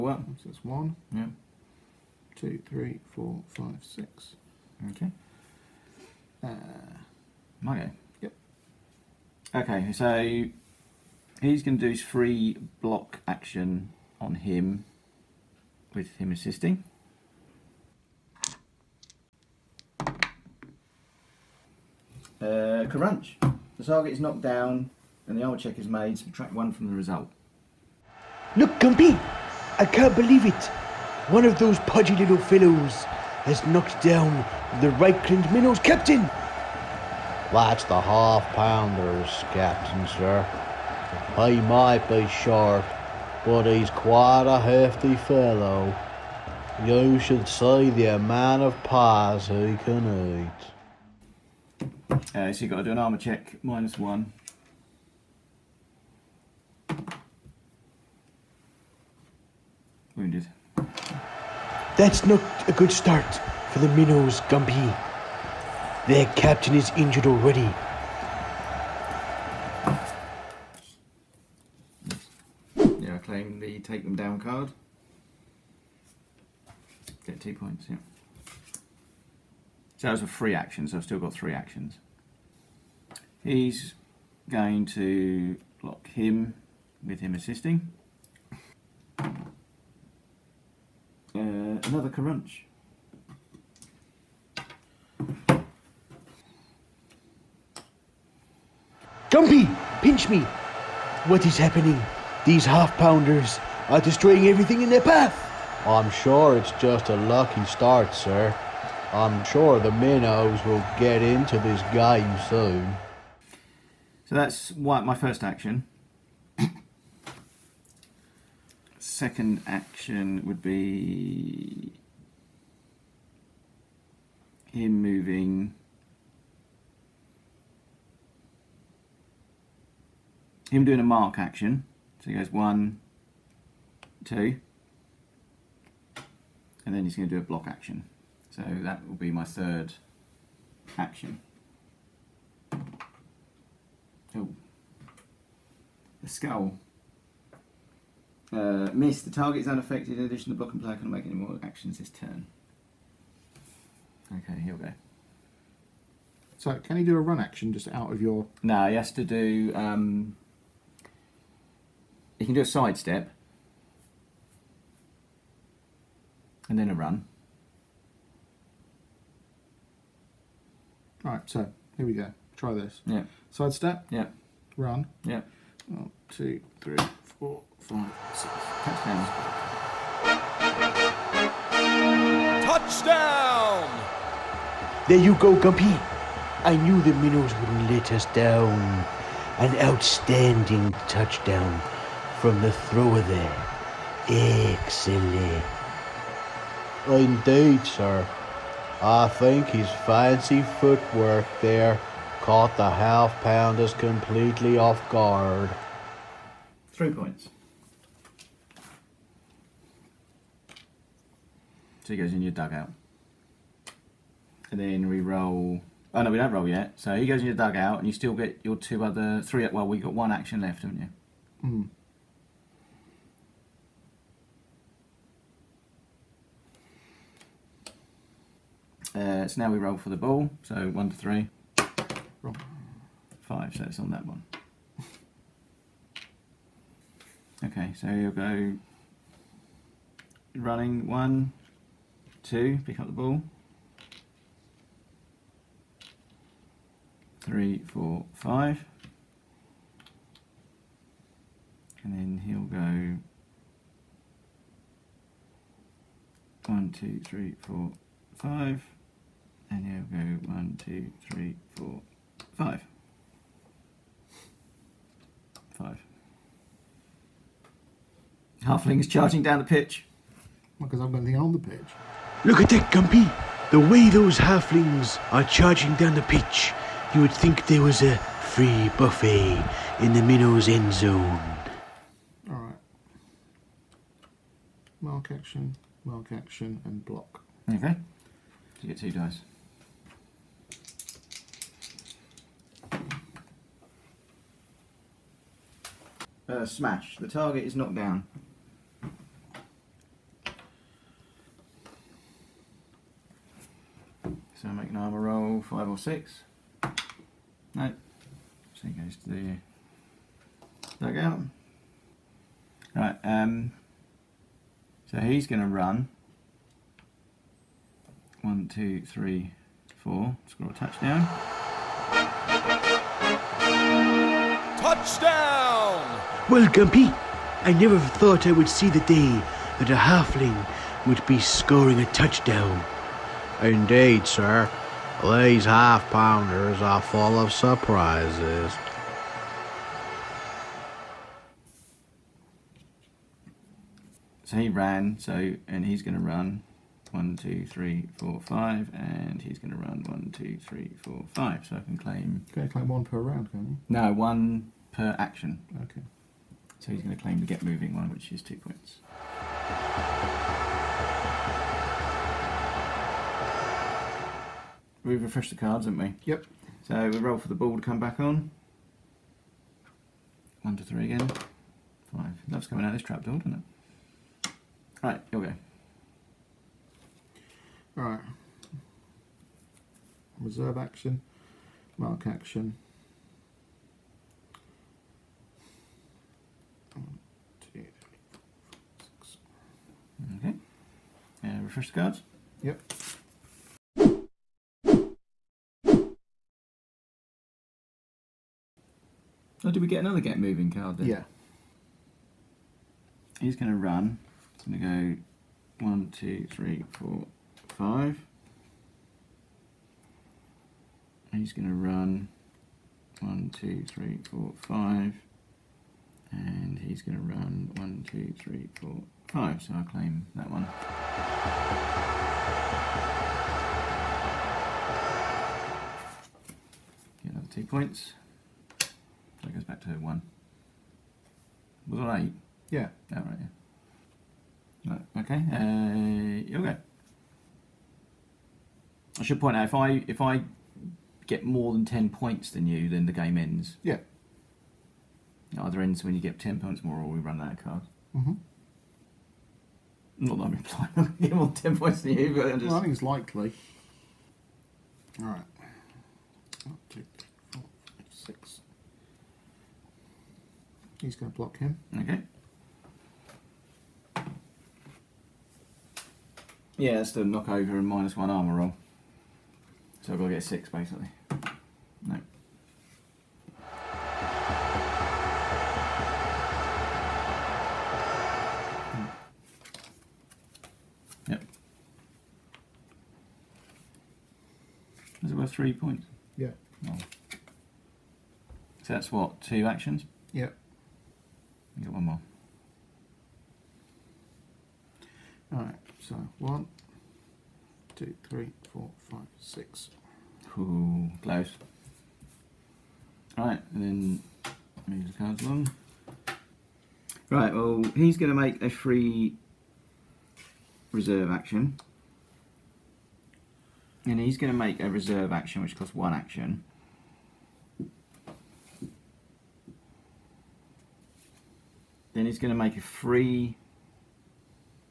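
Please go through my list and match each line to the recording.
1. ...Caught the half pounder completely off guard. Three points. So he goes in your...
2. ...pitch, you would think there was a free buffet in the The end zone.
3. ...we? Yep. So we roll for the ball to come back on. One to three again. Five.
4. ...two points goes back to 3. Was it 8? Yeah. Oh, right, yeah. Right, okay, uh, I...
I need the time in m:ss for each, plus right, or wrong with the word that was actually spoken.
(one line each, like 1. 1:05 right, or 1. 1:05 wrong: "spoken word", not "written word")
1. 3:22 right
2. 4:36 wrong: "Minnows", not "The"
3. 6:06 right
4. 7:07 wrong: "1", not "3".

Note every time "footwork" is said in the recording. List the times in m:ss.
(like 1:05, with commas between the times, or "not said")
3:20.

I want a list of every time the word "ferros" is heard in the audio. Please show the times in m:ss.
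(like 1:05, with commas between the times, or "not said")
not said.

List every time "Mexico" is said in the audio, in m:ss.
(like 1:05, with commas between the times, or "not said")
not said.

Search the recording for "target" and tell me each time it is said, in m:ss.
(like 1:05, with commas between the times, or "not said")
0:23, 2:29, 4:57.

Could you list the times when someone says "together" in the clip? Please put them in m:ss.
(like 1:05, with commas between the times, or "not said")
not said.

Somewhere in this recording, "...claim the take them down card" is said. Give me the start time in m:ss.
1:13.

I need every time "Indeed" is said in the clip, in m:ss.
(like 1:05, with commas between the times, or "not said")
3:17, 5:33.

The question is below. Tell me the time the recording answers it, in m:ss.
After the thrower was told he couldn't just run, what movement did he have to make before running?
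2:42.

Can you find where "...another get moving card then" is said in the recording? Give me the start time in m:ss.
6:39.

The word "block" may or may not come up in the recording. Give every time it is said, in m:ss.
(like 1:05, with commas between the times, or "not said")
0:12, 1:25, 2:17, 2:30, 4:47, 7:41.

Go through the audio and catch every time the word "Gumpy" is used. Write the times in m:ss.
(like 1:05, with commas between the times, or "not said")
0:28, 1:04, 1:39, 3:05, 4:32, 5:26.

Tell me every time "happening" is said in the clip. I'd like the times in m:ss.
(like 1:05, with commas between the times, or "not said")
1:41.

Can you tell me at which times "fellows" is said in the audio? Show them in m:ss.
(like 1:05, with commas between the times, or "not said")
0:32, 0:45.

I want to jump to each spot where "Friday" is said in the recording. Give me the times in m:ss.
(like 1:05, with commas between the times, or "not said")
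not said.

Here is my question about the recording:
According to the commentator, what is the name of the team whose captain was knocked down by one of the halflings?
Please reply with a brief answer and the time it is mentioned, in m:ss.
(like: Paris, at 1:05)
Reikland Minnows, at 0:34.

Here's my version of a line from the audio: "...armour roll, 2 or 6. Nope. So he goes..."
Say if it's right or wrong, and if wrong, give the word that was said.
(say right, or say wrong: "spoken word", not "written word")
wrong: "5", not "2".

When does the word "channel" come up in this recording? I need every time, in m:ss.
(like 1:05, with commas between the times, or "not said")
not said.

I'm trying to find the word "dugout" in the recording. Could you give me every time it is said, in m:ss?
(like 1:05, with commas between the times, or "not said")
3:32, 3:37, 5:11.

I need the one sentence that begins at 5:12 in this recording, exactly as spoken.
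Right, um, so he's going to run.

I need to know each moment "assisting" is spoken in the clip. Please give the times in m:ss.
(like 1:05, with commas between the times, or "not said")
0:16, 1:27.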